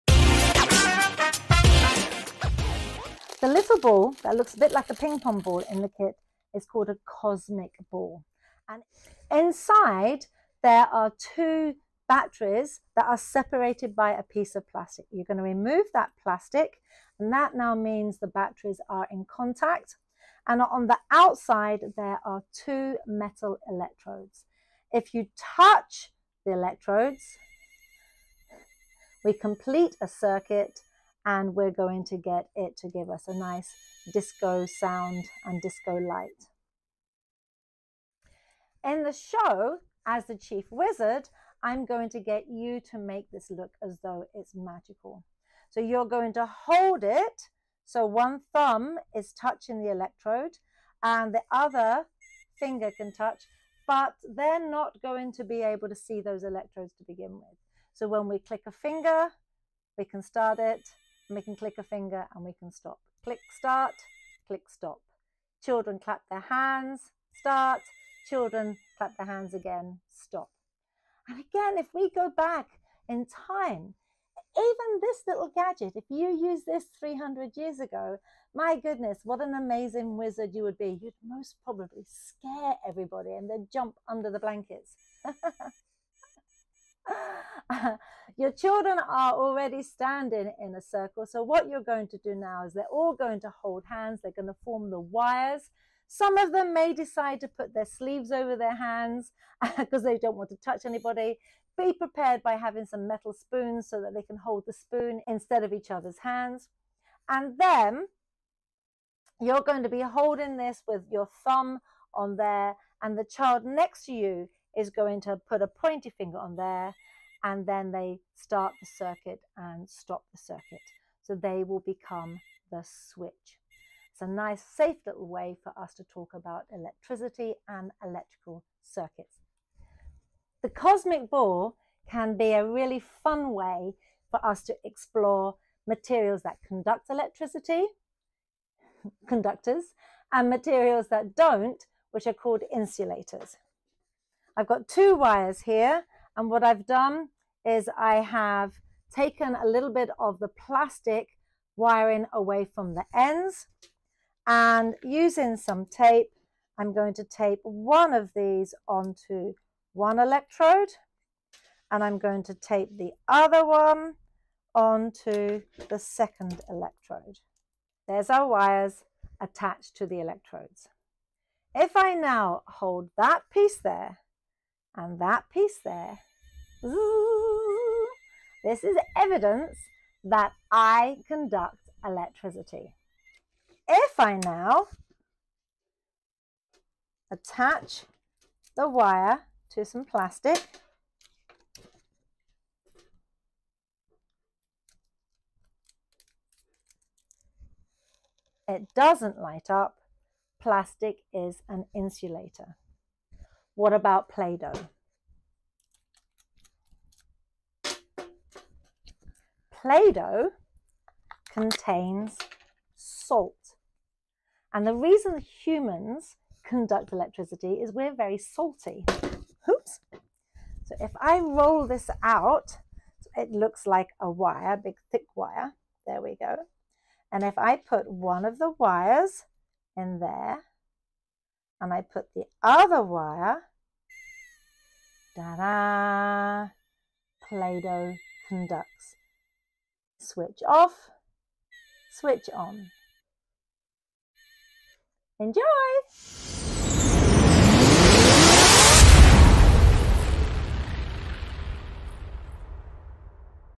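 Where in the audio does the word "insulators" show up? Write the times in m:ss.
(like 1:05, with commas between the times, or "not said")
2:22, 3:21.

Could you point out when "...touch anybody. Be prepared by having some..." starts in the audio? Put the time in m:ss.
1:40.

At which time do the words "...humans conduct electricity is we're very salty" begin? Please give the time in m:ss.
3:35.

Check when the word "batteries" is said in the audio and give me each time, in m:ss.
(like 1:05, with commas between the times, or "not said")
0:12, 0:18.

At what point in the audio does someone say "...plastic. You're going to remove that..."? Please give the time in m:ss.
0:14.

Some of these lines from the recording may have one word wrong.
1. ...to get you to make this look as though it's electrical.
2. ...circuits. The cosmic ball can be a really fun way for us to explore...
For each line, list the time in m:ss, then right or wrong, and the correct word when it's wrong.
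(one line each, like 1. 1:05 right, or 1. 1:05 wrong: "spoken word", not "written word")
1. 0:42 wrong: "magical", not "electrical"
2. 2:08 right.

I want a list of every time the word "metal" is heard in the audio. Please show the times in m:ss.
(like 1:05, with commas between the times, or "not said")
0:23, 1:43.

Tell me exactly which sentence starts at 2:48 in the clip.
There's our wires attached to the electrodes.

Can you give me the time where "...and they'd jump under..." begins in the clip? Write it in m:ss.
1:23.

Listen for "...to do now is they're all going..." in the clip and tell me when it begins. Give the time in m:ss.
1:32.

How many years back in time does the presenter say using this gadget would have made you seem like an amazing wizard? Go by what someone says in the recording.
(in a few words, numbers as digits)
300.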